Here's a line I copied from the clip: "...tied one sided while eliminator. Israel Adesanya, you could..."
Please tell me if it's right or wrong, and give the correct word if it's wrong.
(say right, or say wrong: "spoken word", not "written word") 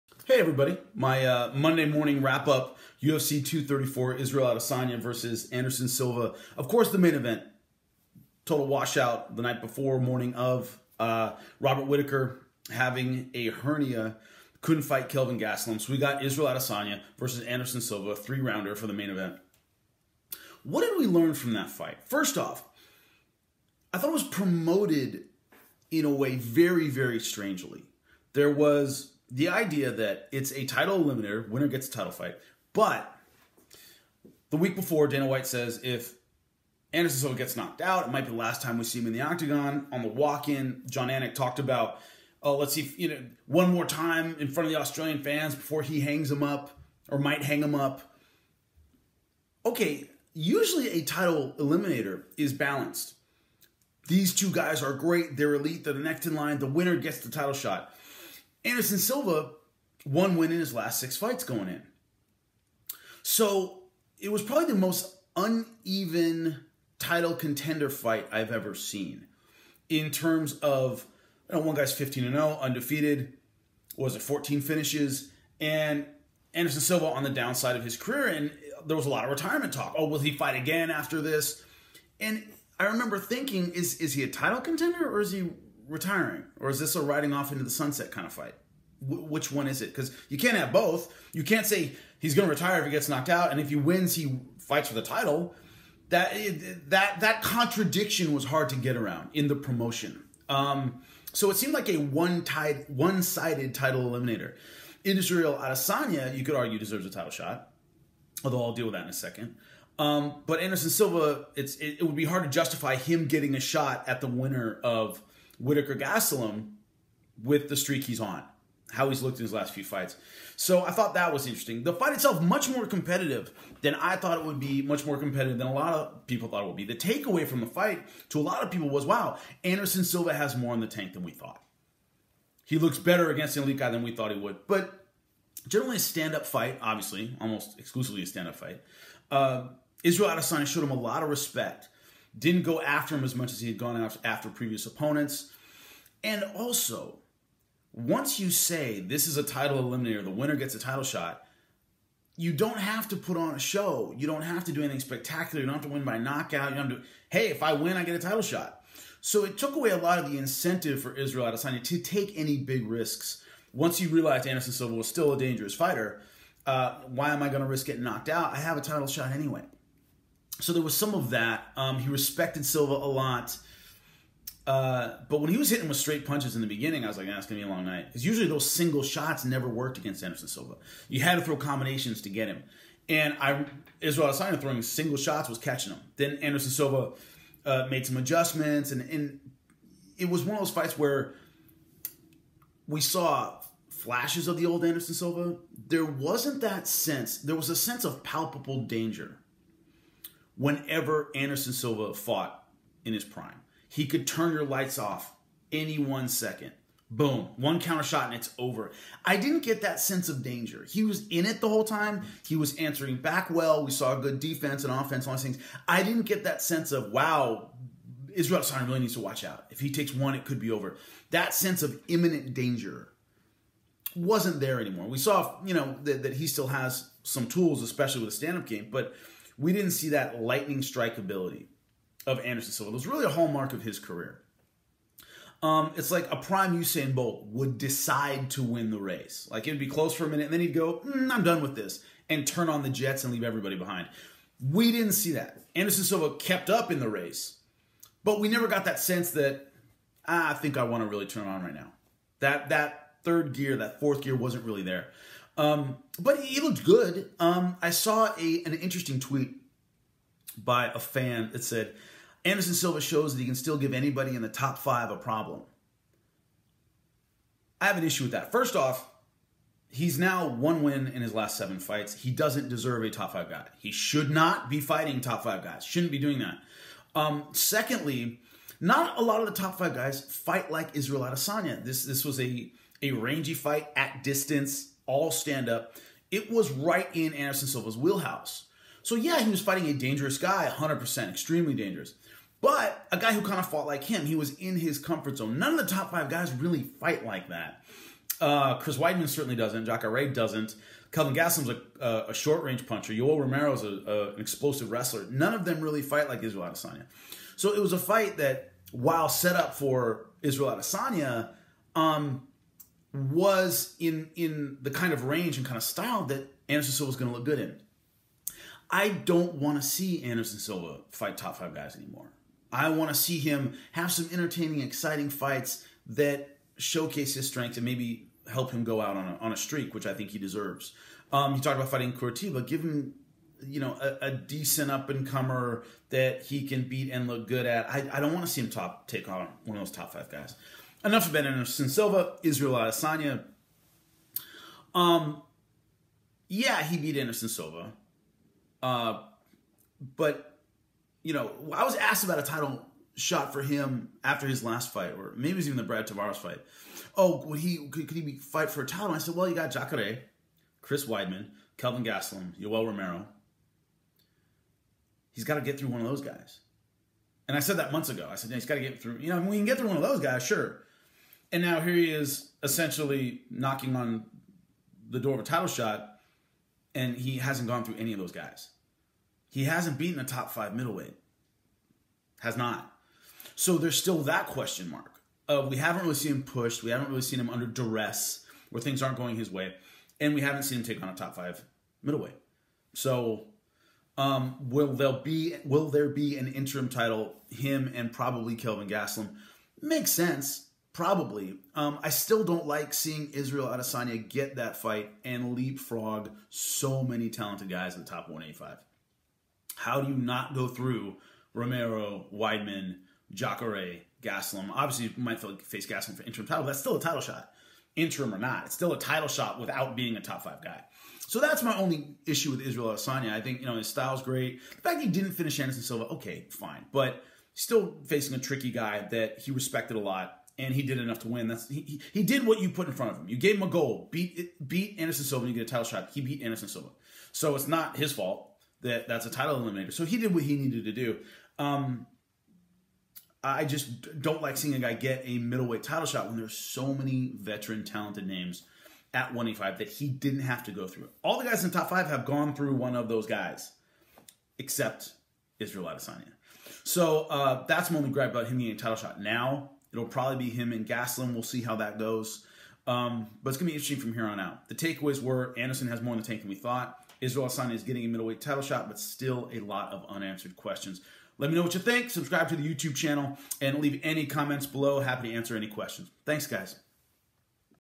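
wrong: "title", not "while".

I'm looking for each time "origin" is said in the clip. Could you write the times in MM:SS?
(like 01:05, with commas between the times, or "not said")
not said.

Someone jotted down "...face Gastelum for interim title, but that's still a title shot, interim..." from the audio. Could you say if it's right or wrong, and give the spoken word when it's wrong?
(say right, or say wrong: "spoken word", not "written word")
right.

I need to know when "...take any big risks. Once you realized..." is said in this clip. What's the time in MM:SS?
02:41.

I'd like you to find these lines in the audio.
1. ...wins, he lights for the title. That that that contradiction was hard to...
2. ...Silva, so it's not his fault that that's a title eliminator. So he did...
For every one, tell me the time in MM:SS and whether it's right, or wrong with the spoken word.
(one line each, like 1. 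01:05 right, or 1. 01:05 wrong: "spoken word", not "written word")
1. 01:33 wrong: "fights", not "lights"
2. 07:16 right.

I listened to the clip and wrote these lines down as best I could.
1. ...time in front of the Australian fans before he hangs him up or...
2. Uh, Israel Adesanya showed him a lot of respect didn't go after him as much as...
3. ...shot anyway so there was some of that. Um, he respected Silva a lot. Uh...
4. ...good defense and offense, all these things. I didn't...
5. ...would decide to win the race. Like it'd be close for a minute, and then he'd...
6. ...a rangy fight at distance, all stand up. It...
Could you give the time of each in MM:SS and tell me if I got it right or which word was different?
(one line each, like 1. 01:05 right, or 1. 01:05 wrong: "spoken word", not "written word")
1. 00:43 right
2. 02:19 right
3. 02:49 right
4. 03:34 right
5. 03:57 right
6. 04:43 right.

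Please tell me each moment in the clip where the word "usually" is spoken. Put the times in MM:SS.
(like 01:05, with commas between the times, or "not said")
00:50, 02:58.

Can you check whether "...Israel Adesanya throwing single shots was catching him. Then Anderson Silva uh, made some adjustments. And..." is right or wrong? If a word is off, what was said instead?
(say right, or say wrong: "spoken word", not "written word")
right.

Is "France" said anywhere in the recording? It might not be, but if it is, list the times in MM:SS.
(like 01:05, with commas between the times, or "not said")
not said.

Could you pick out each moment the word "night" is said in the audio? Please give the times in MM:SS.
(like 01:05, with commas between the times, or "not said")
00:09, 02:57.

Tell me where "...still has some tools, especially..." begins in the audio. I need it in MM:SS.
03:46.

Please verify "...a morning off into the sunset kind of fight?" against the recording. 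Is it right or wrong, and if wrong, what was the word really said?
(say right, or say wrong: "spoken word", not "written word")
wrong: "riding", not "morning".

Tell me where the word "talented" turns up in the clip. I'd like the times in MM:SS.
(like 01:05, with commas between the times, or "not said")
06:47, 07:27.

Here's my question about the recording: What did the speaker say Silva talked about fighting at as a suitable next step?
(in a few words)
Curitiba.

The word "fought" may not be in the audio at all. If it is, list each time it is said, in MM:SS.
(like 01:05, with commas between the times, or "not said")
03:22, 04:53.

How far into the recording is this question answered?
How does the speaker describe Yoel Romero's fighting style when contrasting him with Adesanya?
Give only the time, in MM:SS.
05:04.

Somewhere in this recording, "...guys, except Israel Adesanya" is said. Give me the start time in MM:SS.
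07:33.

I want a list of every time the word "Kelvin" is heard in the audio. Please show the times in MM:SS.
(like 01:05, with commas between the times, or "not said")
00:15, 05:01, 06:01, 06:38.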